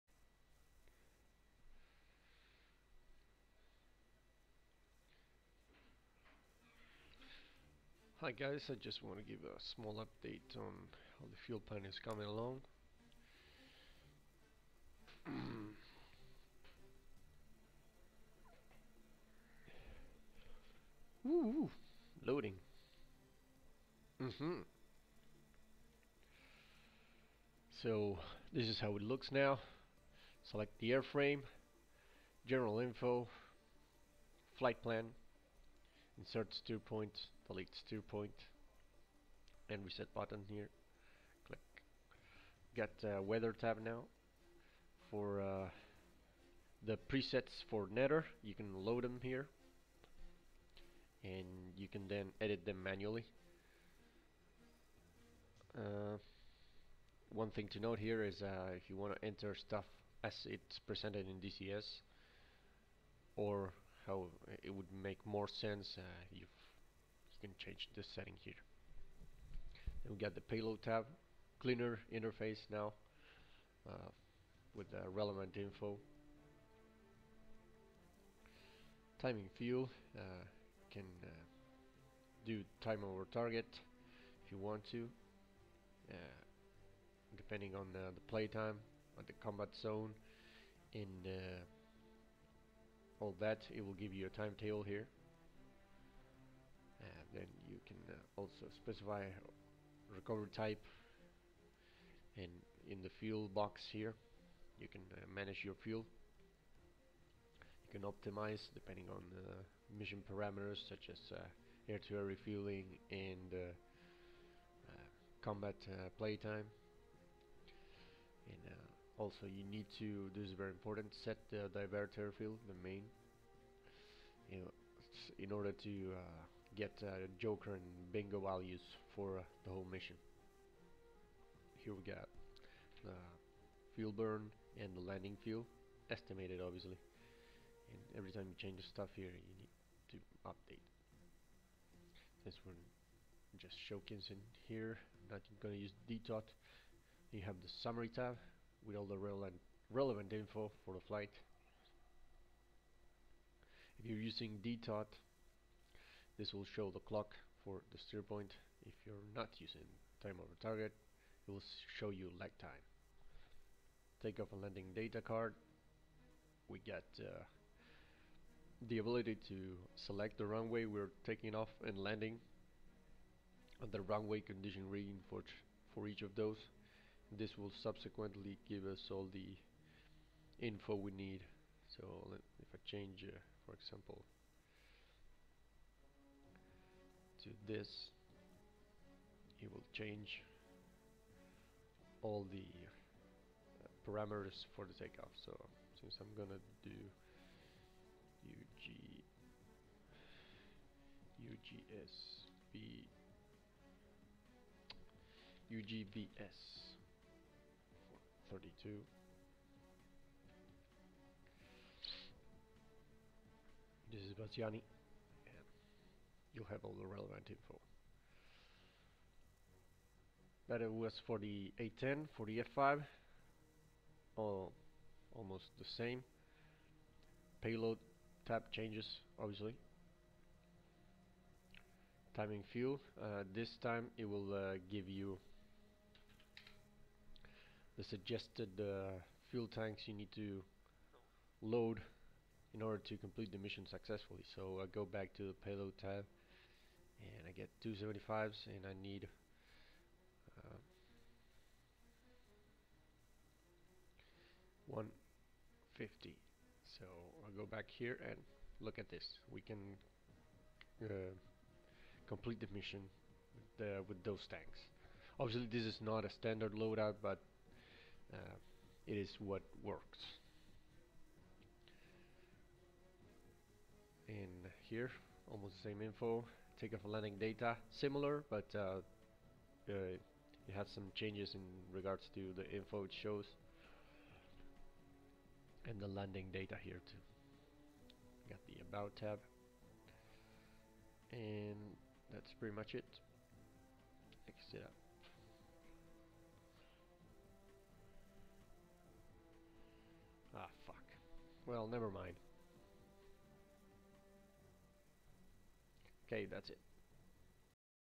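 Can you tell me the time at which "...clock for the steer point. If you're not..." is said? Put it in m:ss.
2:36.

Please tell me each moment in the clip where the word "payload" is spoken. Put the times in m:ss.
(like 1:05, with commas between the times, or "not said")
1:10, 3:47, 4:05.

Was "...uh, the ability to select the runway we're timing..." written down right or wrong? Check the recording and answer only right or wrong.
wrong.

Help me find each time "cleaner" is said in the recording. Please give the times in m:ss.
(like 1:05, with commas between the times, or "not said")
1:11.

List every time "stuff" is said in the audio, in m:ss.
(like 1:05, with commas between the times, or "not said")
0:59, 2:18.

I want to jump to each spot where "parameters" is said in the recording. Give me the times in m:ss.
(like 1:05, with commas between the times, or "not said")
1:50, 3:14.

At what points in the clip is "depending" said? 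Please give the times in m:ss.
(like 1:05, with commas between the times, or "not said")
1:27, 1:48.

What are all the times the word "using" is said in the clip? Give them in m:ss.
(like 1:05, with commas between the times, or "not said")
2:34, 2:39.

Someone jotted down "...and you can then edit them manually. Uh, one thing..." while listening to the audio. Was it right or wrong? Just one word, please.
right.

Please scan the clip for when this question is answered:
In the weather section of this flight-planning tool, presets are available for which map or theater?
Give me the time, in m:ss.
0:47.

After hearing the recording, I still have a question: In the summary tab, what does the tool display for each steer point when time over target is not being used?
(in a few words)
Lag time.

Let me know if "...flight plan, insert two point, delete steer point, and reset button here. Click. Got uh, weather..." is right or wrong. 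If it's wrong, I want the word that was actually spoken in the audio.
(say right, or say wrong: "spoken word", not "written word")
right.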